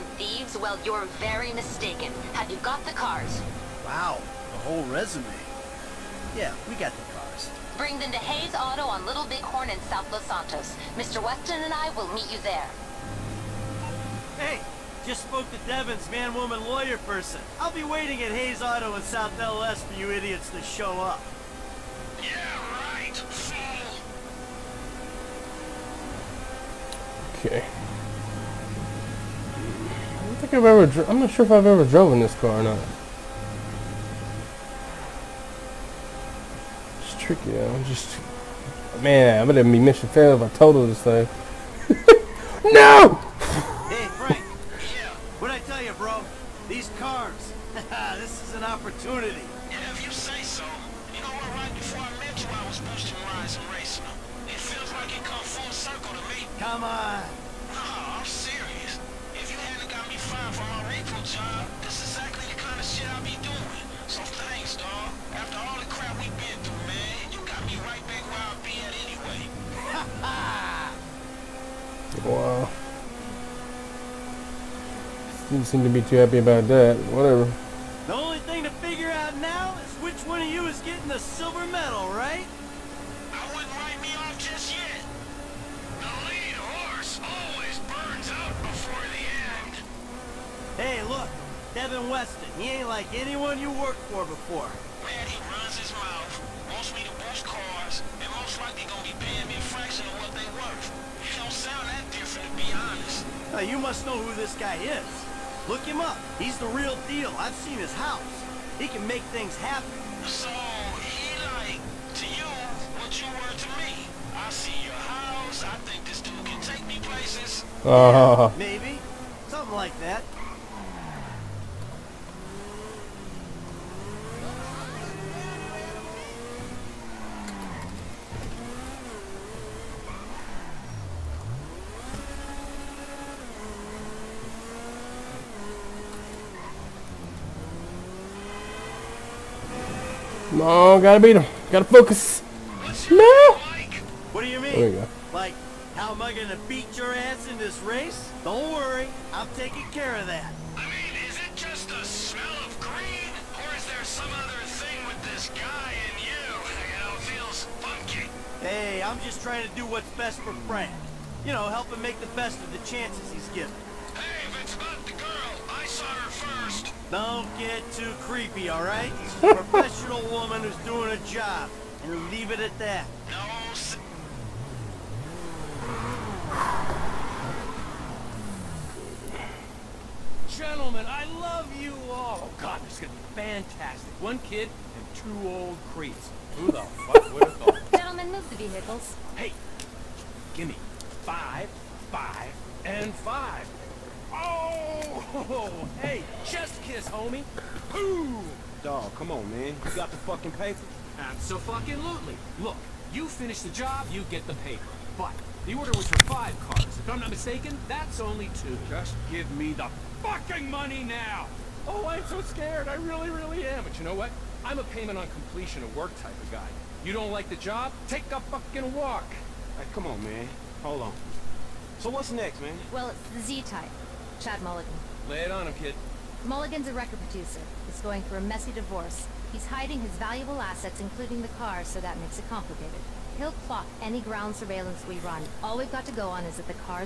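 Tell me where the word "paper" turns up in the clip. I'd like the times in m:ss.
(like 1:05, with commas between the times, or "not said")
3:20, 3:24.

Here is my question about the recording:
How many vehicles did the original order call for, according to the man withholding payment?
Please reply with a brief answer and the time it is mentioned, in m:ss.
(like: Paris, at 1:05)
5, at 3:26.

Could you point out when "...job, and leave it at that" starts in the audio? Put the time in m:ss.
2:51.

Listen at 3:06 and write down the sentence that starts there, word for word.
Who the fuck would have thought?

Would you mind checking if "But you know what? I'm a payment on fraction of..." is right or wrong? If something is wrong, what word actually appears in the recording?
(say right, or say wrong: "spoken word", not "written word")
wrong: "completion", not "fraction".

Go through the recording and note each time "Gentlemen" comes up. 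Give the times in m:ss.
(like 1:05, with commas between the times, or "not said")
3:00, 3:07.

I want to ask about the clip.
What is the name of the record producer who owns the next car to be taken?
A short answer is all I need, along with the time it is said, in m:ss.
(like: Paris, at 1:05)
Chad Mulligan, at 3:44.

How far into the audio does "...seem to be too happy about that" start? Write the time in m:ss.
1:15.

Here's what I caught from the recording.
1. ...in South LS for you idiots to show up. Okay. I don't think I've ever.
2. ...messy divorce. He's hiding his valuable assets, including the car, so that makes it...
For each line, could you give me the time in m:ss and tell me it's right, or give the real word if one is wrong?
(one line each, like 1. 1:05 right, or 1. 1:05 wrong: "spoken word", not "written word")
1. 0:18 right
2. 3:48 right.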